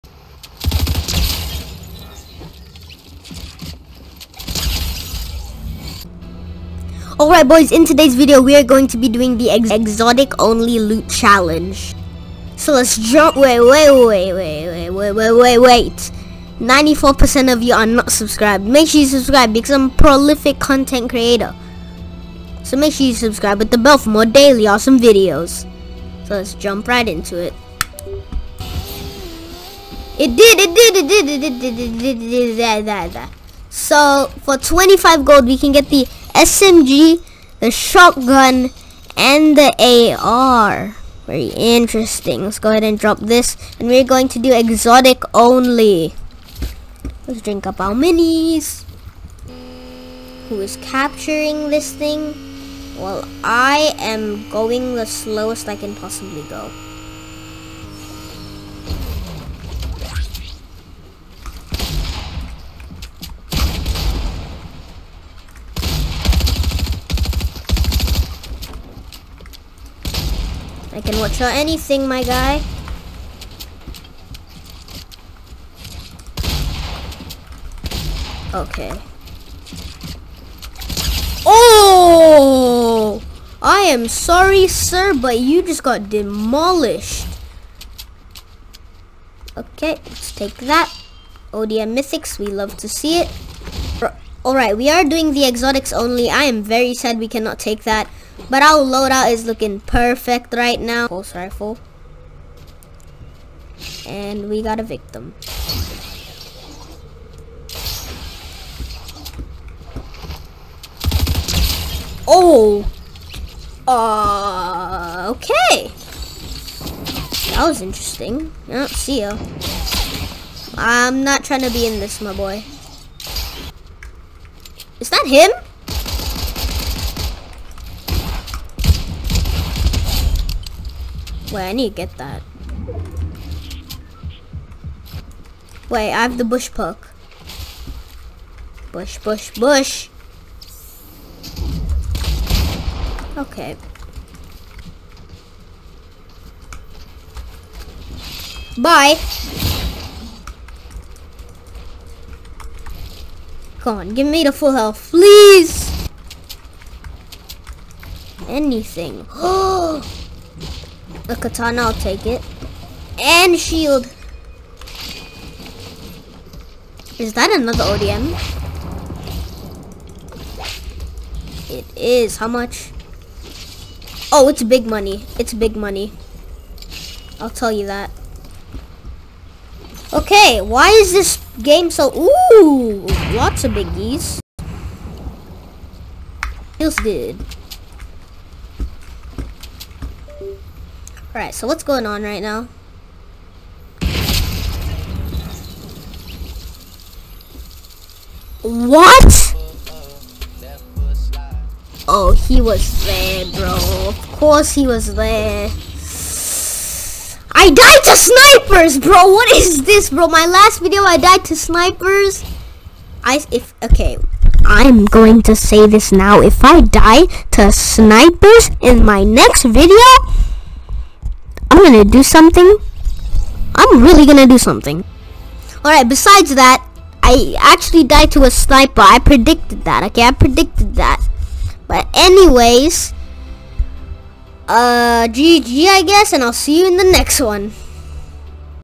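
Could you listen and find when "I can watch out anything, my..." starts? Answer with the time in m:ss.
1:10.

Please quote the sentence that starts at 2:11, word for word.
Wait, I need to get that.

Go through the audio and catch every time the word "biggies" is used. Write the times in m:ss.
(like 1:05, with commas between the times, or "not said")
3:03.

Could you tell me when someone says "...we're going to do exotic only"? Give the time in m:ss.
0:43.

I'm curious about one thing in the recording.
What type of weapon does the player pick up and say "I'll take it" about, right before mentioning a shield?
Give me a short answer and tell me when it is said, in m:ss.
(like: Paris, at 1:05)
katana, at 2:41.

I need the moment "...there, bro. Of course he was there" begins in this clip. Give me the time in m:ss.
3:23.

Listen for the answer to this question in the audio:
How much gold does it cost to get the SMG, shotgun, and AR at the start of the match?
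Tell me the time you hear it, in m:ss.
0:34.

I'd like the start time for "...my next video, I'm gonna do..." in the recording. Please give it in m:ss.
3:39.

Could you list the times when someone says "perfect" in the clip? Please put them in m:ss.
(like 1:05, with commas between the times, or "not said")
1:39.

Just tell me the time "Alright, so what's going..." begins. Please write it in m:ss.
3:11.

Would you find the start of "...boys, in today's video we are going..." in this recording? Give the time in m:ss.
0:07.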